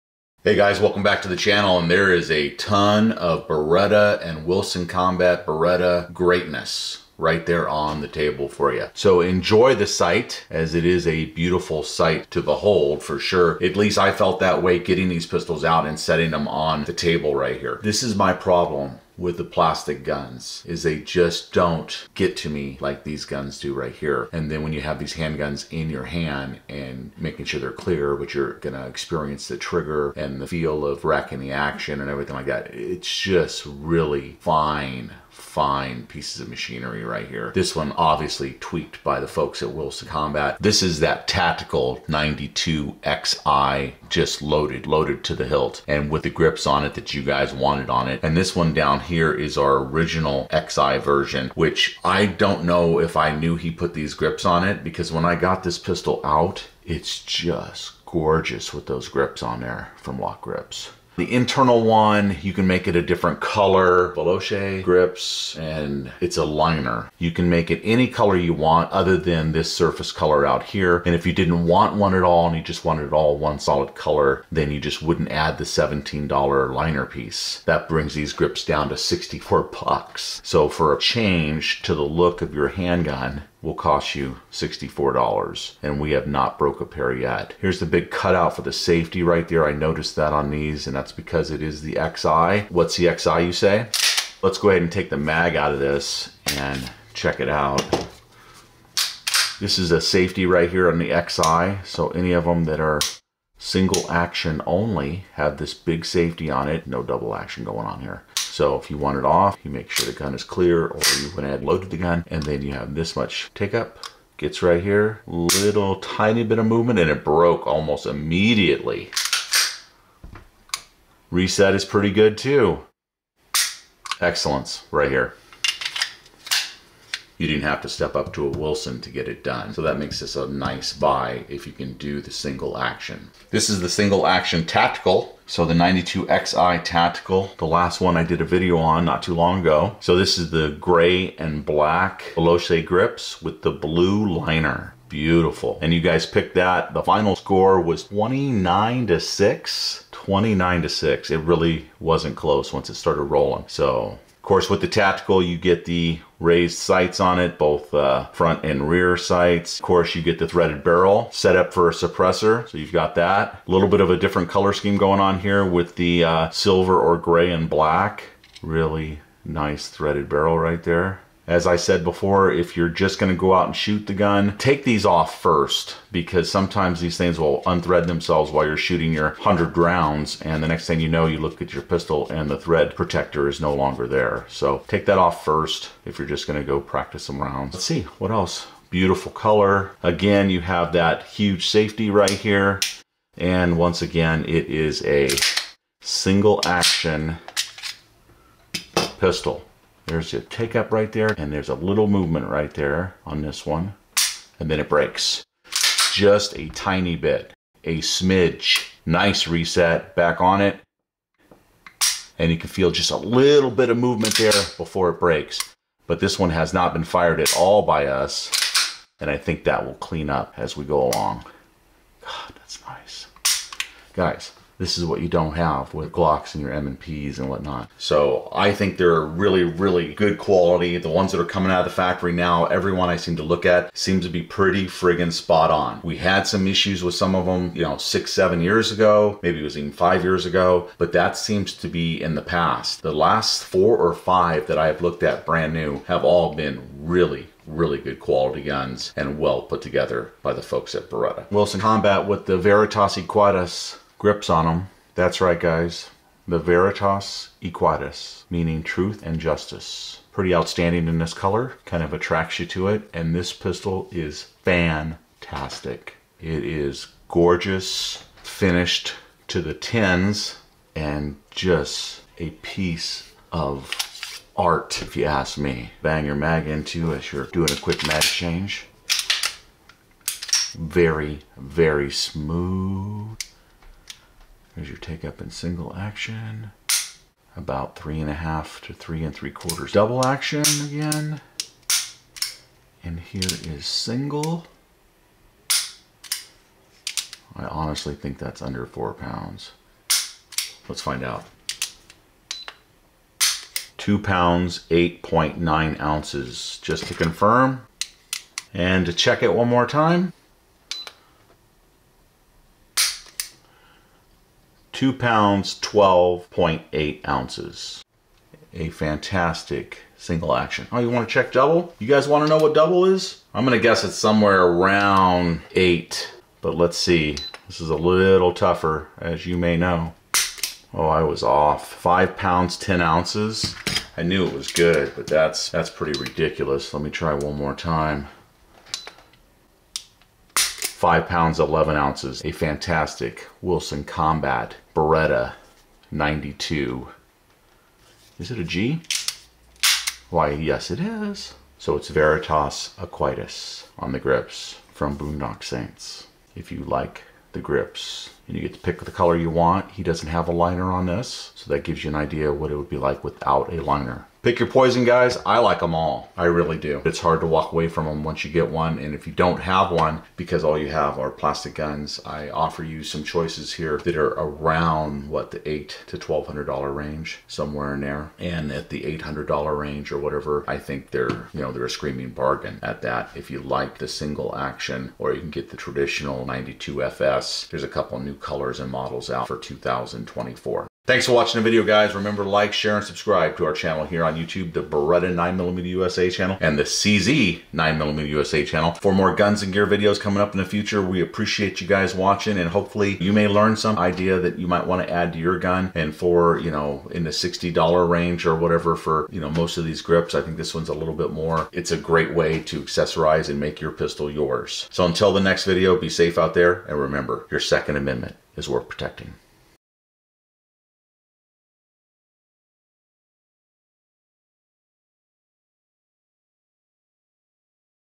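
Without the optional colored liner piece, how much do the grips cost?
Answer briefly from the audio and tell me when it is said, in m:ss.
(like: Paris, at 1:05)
$64, at 1:18.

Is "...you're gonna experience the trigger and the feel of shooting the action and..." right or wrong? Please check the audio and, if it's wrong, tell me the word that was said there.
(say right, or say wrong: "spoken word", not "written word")
wrong: "racking", not "shooting".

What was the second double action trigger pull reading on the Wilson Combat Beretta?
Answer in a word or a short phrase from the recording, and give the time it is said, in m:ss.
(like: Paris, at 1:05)
5 pounds 11 ounces, at 5:41.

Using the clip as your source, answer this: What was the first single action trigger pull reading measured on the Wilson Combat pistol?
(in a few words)
2 pounds 8.9 ounces.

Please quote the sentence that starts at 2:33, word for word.
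So, of course, with the tactical, you get the raised sights on it, both uh, front and rear sights.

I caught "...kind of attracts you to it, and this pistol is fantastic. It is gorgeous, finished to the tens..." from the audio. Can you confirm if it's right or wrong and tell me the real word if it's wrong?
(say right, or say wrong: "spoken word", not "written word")
right.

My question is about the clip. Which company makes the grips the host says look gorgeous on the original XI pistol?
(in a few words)
LOK Grips.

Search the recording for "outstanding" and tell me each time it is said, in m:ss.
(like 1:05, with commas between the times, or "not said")
4:20.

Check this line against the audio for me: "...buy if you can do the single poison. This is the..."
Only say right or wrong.
wrong.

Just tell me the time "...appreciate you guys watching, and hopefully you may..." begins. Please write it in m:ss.
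6:41.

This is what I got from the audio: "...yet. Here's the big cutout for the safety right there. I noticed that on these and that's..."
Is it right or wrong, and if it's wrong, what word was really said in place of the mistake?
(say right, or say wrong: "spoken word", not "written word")
right.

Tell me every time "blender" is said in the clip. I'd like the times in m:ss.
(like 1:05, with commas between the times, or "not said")
not said.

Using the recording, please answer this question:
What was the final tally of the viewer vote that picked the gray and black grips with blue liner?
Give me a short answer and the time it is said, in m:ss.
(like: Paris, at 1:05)
29 to 6, at 2:26.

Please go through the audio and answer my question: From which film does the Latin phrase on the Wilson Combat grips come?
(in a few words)
Boondock Saints.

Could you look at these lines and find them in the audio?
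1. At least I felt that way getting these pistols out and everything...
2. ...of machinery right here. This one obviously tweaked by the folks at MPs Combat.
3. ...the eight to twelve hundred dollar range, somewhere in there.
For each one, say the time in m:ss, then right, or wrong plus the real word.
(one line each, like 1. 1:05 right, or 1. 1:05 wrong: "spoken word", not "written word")
1. 0:13 wrong: "setting", not "everything"
2. 0:36 wrong: "Wilson", not "MPs"
3. 6:15 right.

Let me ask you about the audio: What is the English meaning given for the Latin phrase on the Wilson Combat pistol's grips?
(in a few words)
truth and justice.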